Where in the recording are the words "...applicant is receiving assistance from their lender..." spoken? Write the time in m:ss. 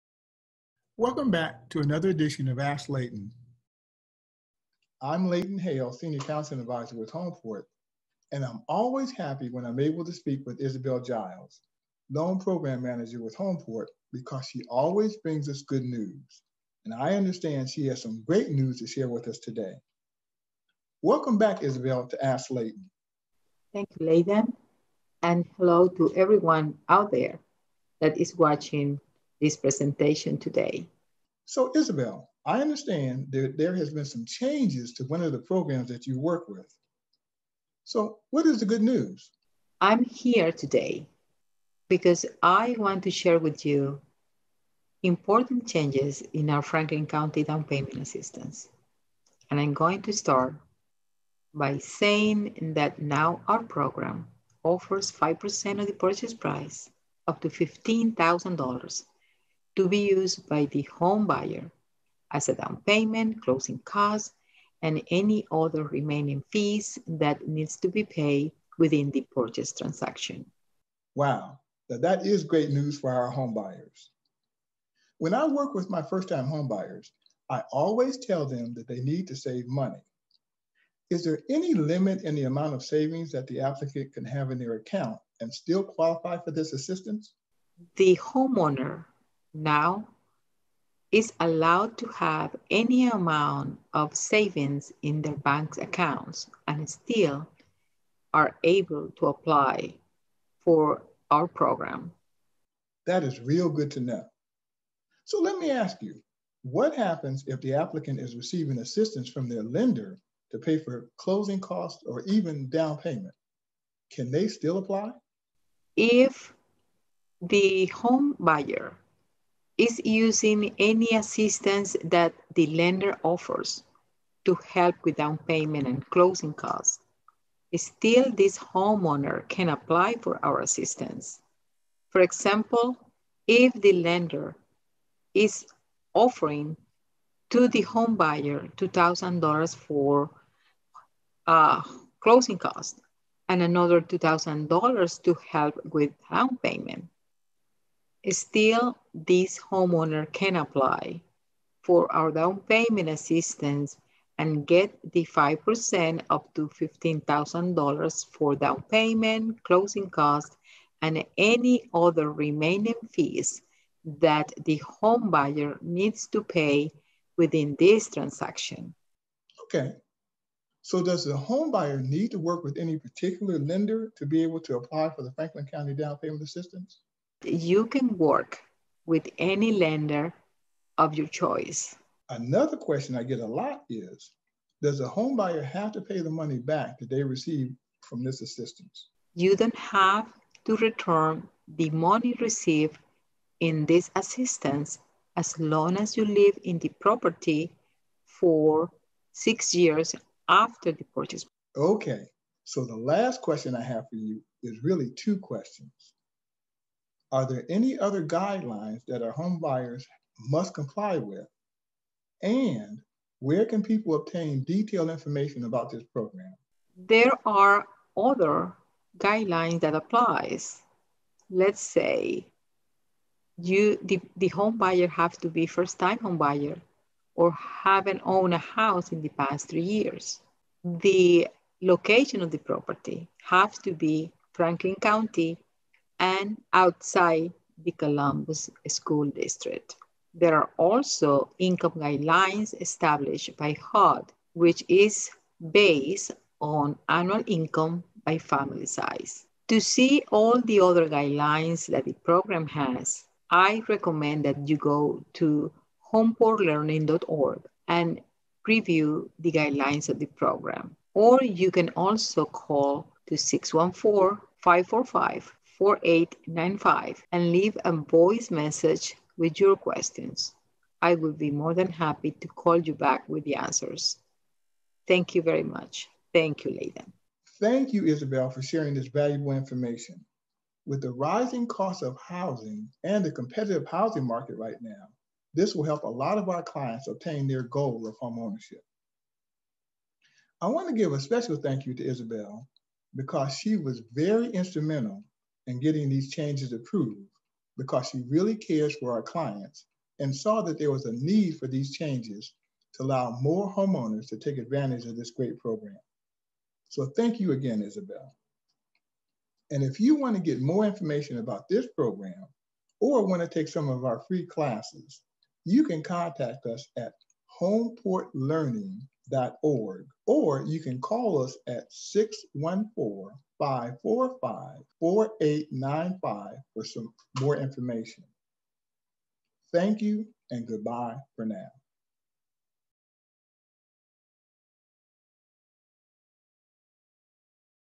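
1:47.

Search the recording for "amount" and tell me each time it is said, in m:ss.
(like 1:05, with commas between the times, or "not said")
1:22, 1:33.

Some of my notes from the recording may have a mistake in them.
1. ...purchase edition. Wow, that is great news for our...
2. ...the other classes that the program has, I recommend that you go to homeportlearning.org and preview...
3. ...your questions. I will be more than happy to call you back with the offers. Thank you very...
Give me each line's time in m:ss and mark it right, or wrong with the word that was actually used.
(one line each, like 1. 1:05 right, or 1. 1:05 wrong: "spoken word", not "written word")
1. 1:09 wrong: "transaction", not "edition"
2. 4:10 wrong: "guidelines", not "classes"
3. 4:29 wrong: "answers", not "offers".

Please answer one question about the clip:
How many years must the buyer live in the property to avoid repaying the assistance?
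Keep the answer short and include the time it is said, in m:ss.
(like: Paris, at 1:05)
6, at 3:19.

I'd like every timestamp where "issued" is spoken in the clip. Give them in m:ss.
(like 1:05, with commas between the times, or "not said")
not said.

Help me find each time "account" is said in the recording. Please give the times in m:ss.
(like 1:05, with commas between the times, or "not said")
1:24, 1:35.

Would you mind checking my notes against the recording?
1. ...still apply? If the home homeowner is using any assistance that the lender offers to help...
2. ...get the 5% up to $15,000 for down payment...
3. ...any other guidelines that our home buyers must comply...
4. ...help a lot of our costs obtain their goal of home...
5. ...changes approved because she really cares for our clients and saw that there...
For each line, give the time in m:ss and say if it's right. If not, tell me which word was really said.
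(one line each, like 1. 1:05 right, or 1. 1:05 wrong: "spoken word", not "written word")
1. 1:54 wrong: "buyer", not "homeowner"
2. 2:34 right
3. 3:27 right
4. 4:45 wrong: "clients", not "costs"
5. 4:56 right.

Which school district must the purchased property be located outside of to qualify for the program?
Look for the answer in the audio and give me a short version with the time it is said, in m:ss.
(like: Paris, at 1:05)
Columbus School District, at 3:57.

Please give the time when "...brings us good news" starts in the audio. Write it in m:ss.
0:15.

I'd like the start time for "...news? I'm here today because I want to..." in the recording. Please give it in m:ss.
0:38.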